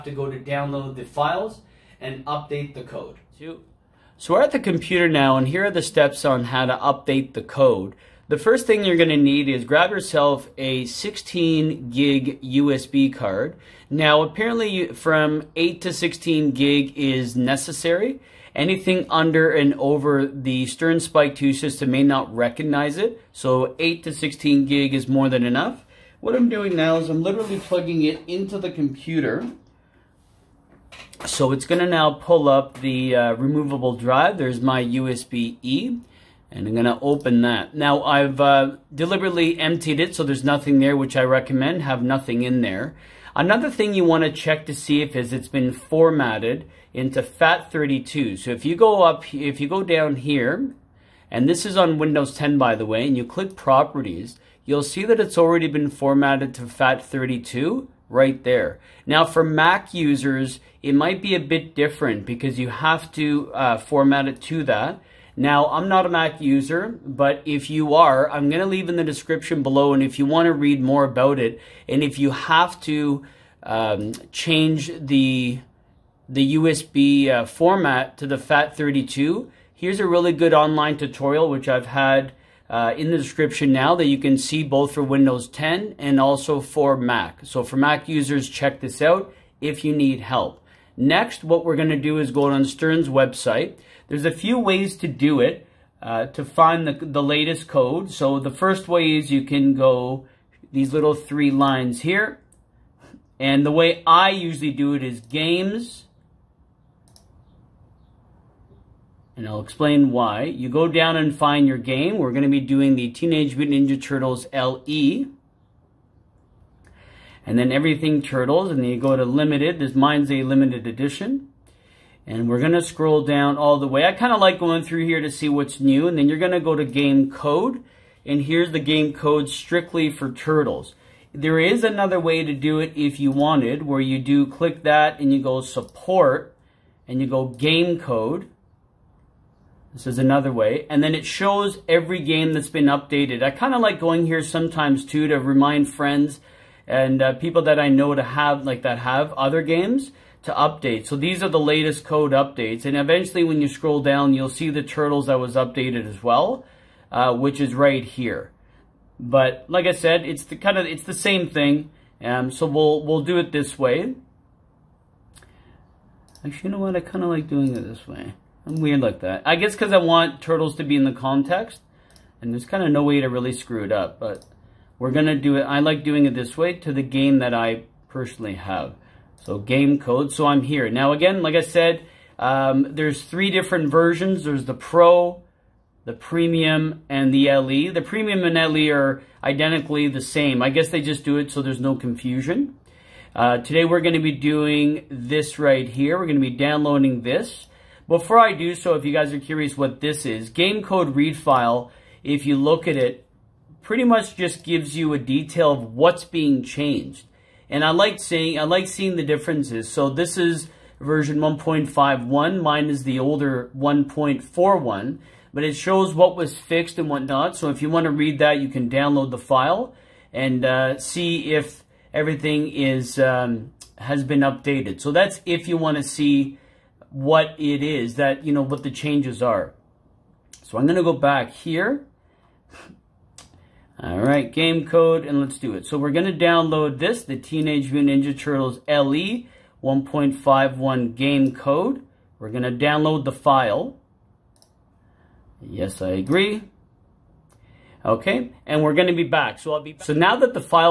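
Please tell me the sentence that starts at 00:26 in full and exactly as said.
What I'm doing now is I'm literally plugging it into the computer.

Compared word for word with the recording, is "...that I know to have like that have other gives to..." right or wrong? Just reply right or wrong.
wrong.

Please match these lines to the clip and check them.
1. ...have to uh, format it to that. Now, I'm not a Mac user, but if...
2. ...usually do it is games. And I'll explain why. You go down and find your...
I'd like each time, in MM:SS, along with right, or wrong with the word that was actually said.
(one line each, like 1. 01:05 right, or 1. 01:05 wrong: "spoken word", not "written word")
1. 01:02 right
2. 01:44 right.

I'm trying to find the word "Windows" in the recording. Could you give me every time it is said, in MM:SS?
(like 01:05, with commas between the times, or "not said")
00:51, 01:25.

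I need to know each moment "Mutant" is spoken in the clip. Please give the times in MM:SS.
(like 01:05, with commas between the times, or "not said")
01:53, 03:57.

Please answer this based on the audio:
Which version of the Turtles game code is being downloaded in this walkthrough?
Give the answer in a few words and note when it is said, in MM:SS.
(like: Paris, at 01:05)
1.51, at 03:30.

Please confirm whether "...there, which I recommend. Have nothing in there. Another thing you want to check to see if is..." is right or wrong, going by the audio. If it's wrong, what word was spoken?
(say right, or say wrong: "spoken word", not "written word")
right.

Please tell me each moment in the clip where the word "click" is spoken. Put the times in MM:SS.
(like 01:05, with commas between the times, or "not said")
00:53, 02:14.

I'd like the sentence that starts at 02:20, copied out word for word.
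And then it shows every game that's been updated.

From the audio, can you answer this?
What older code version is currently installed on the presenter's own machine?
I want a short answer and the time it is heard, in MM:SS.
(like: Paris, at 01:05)
1.41, at 03:33.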